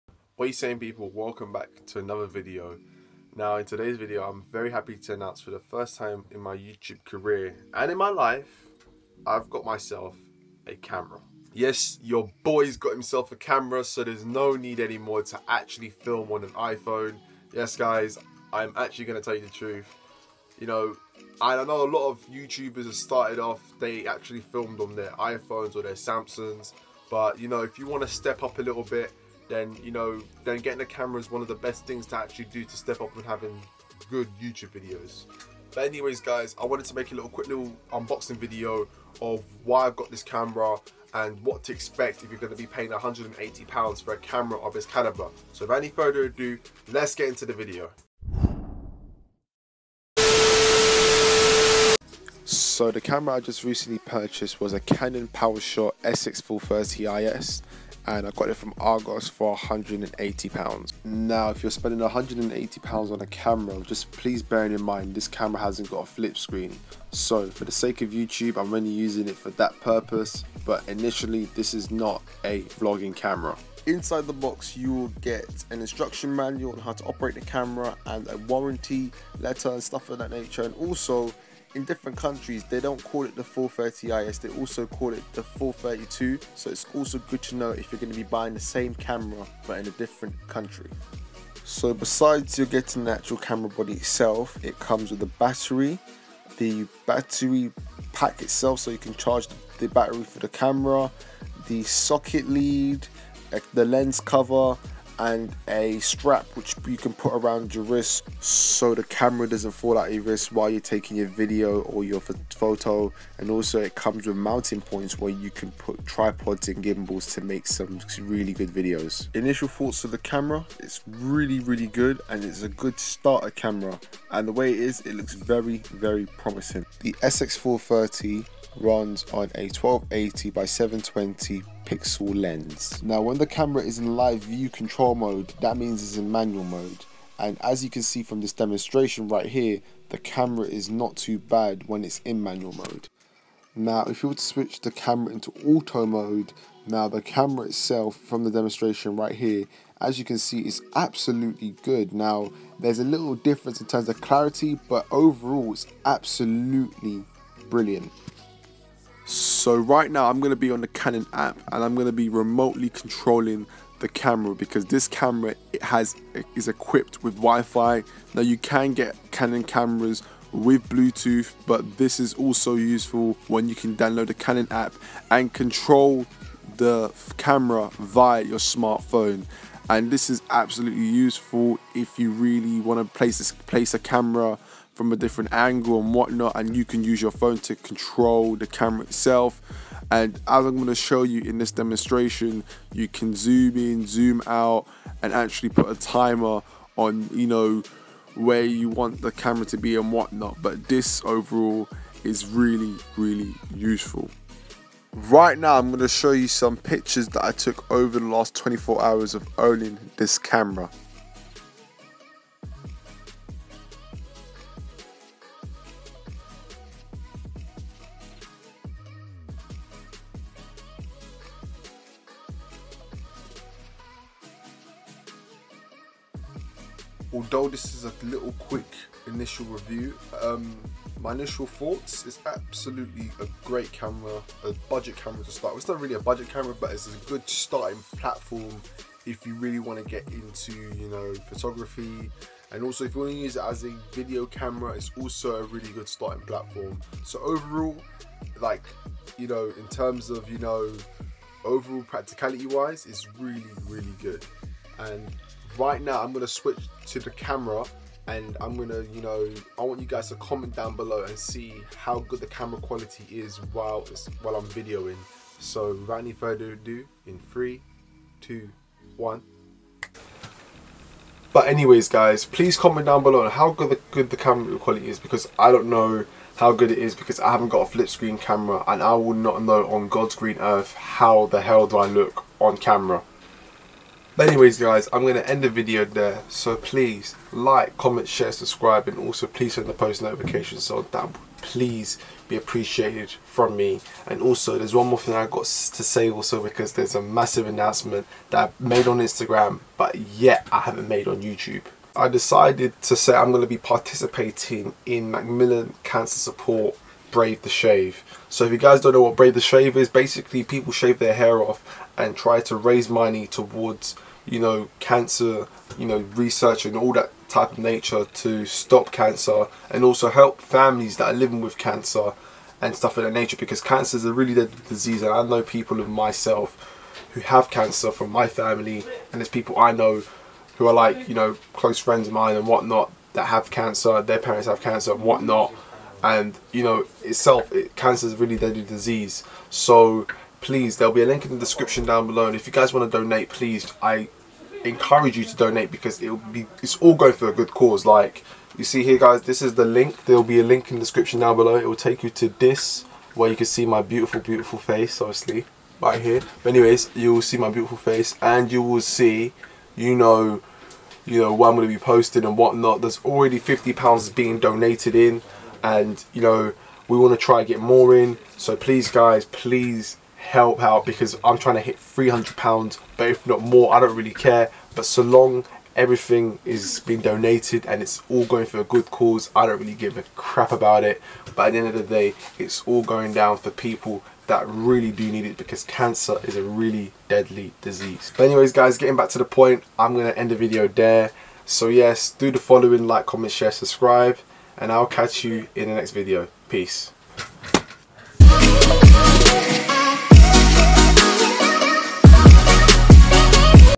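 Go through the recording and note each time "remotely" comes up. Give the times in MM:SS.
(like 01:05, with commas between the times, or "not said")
02:42.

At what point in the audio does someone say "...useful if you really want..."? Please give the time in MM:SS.
03:01.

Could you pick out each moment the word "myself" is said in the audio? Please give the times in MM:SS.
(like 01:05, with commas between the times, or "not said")
00:09, 05:26.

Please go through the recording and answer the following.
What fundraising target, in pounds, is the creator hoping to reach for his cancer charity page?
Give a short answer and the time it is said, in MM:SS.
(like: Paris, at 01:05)
£300, at 06:11.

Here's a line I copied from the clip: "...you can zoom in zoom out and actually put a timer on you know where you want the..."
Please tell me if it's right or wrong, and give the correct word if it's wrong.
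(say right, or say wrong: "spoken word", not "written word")
right.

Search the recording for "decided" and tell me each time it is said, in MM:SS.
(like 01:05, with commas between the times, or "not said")
05:02.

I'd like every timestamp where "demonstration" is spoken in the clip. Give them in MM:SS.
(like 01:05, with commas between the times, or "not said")
02:18, 02:28, 03:11.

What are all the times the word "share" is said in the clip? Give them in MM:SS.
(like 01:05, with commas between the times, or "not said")
04:48, 06:33.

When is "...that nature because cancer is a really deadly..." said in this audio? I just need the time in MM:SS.
05:23.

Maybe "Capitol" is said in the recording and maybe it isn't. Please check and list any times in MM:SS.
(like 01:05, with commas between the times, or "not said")
not said.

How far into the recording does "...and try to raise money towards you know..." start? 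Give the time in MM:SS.
05:12.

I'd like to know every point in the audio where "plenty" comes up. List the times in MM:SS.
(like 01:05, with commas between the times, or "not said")
not said.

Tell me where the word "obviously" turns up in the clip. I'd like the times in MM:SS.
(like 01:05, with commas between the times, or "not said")
05:55.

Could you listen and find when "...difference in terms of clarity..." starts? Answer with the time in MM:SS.
02:33.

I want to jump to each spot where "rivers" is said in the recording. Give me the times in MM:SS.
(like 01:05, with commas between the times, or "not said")
not said.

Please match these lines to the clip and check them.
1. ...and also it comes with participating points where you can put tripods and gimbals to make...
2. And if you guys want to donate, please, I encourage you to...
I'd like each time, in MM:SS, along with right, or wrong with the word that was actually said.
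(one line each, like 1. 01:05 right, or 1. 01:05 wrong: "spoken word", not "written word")
1. 01:53 wrong: "mounting", not "participating"
2. 05:42 right.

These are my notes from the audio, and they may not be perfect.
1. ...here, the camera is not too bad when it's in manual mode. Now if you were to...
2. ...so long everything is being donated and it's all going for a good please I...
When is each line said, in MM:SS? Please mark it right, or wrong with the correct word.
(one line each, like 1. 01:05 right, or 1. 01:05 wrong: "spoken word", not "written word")
1. 02:19 right
2. 06:15 wrong: "cause", not "please".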